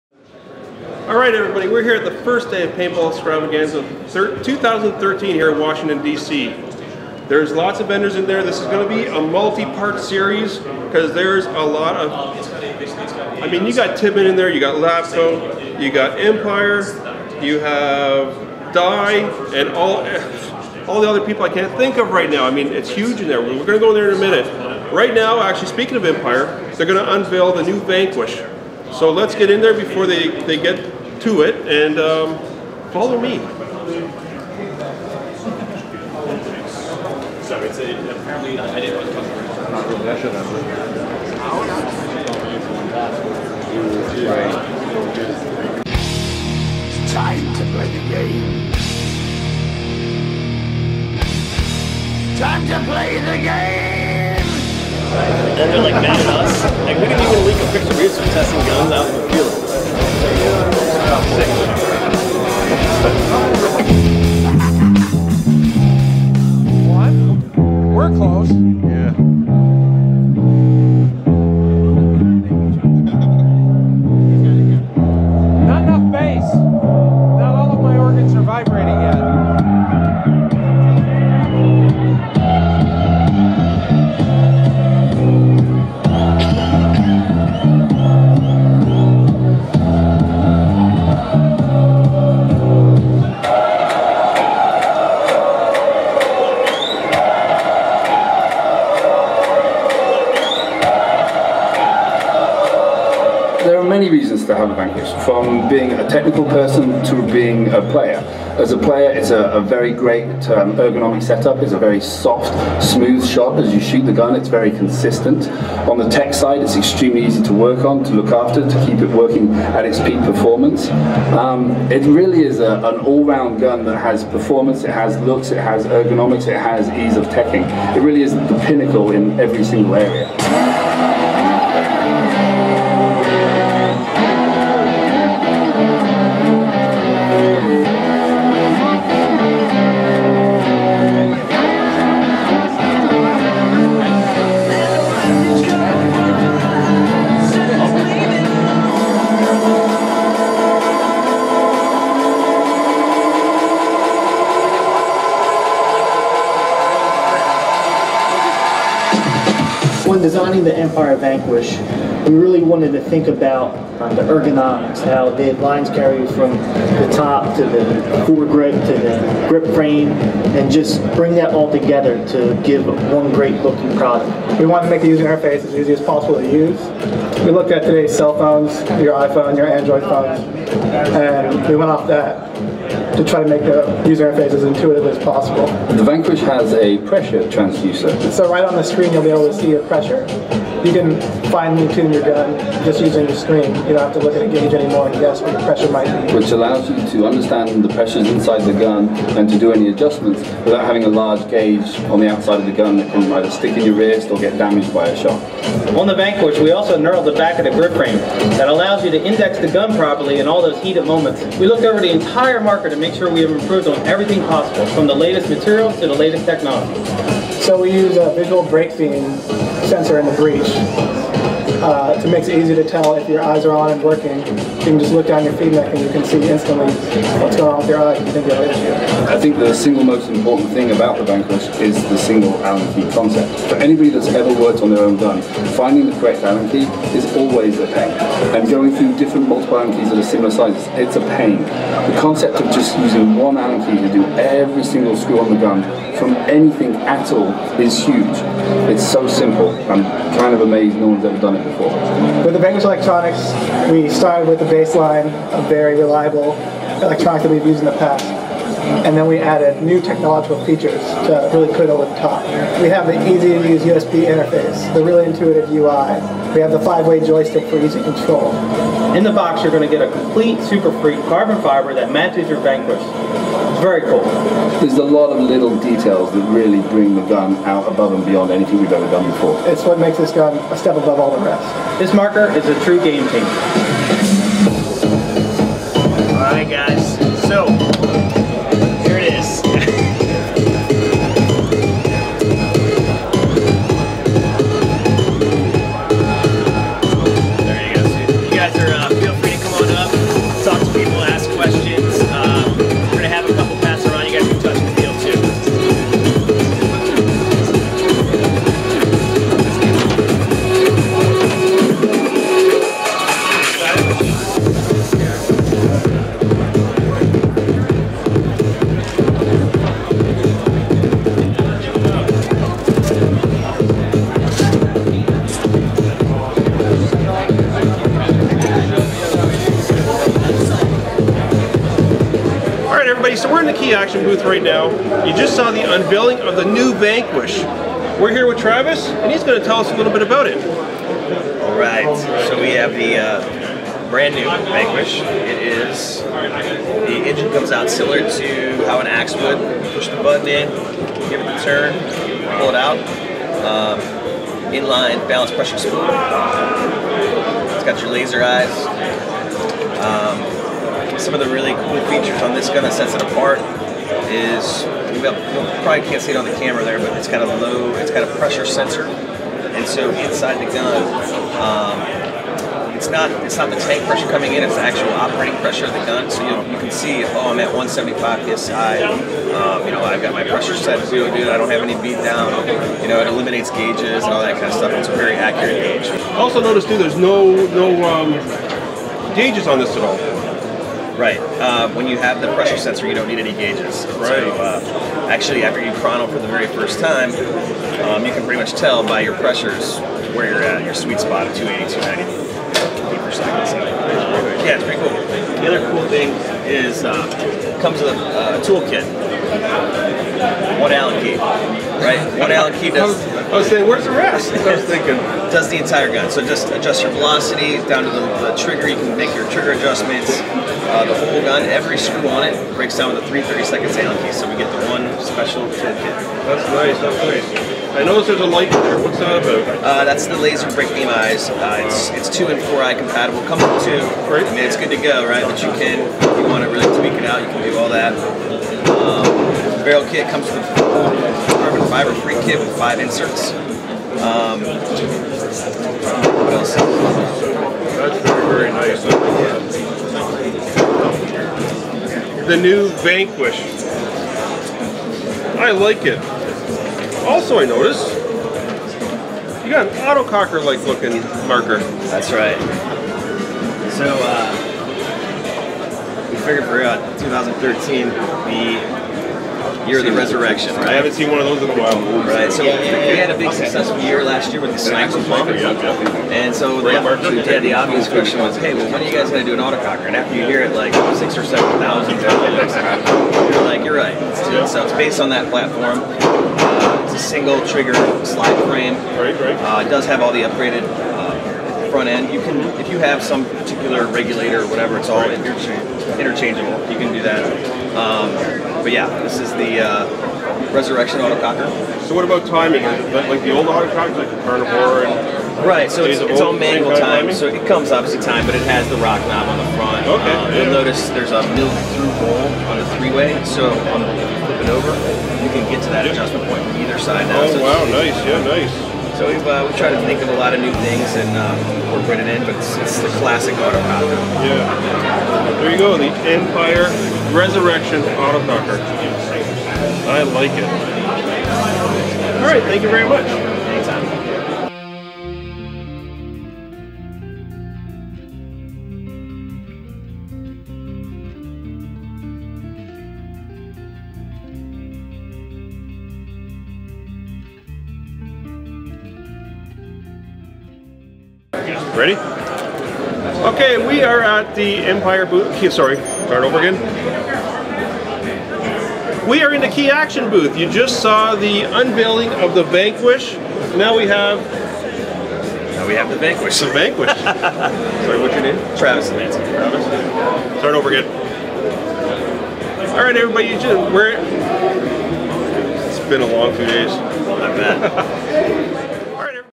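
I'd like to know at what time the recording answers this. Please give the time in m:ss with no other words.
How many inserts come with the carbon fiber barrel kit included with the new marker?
7:22.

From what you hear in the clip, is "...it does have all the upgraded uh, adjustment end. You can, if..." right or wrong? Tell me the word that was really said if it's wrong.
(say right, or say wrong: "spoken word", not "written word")
wrong: "front", not "adjustment".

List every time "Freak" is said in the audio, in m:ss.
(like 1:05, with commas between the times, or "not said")
4:31, 7:22.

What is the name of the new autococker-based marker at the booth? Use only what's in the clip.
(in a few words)
Resurrection Autococker.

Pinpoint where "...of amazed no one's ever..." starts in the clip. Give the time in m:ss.
4:10.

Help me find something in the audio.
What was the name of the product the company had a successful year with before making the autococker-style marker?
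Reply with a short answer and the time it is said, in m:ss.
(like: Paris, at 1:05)
Sniper, at 7:54.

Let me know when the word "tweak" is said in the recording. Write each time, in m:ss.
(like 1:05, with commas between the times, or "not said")
7:16.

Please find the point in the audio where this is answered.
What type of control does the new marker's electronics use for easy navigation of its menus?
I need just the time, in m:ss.
4:26.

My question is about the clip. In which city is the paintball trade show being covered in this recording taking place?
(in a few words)
Washington, D.C.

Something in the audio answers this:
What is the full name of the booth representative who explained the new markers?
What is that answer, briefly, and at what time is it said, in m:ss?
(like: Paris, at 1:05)
Travis Lance, at 9:28.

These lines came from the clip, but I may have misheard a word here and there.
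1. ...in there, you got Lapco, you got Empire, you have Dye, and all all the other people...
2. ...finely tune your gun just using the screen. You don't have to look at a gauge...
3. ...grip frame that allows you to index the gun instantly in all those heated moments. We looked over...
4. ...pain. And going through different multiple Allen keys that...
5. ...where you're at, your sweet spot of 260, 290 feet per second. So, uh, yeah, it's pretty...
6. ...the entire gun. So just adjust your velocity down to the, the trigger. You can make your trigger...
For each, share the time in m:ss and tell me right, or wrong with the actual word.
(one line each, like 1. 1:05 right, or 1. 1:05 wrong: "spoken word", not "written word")
1. 0:14 right
2. 3:11 right
3. 3:27 wrong: "properly", not "instantly"
4. 3:57 right
5. 6:40 wrong: "280", not "260"
6. 6:55 right.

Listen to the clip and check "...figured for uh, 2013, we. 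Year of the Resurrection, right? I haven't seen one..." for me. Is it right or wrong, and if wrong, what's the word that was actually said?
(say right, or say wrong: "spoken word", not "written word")
right.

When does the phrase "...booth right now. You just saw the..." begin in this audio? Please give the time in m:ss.
5:34.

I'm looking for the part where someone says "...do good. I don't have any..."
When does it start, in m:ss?
6:21.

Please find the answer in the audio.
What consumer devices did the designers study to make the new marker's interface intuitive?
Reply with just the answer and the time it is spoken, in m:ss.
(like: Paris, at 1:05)
cell phones, at 2:58.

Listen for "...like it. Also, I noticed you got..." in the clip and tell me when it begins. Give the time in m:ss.
7:35.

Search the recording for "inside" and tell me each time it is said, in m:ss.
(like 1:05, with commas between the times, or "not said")
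3:18, 6:10.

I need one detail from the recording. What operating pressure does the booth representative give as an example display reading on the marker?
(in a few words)
175 psi.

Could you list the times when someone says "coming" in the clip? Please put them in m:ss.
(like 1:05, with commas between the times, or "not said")
6:14.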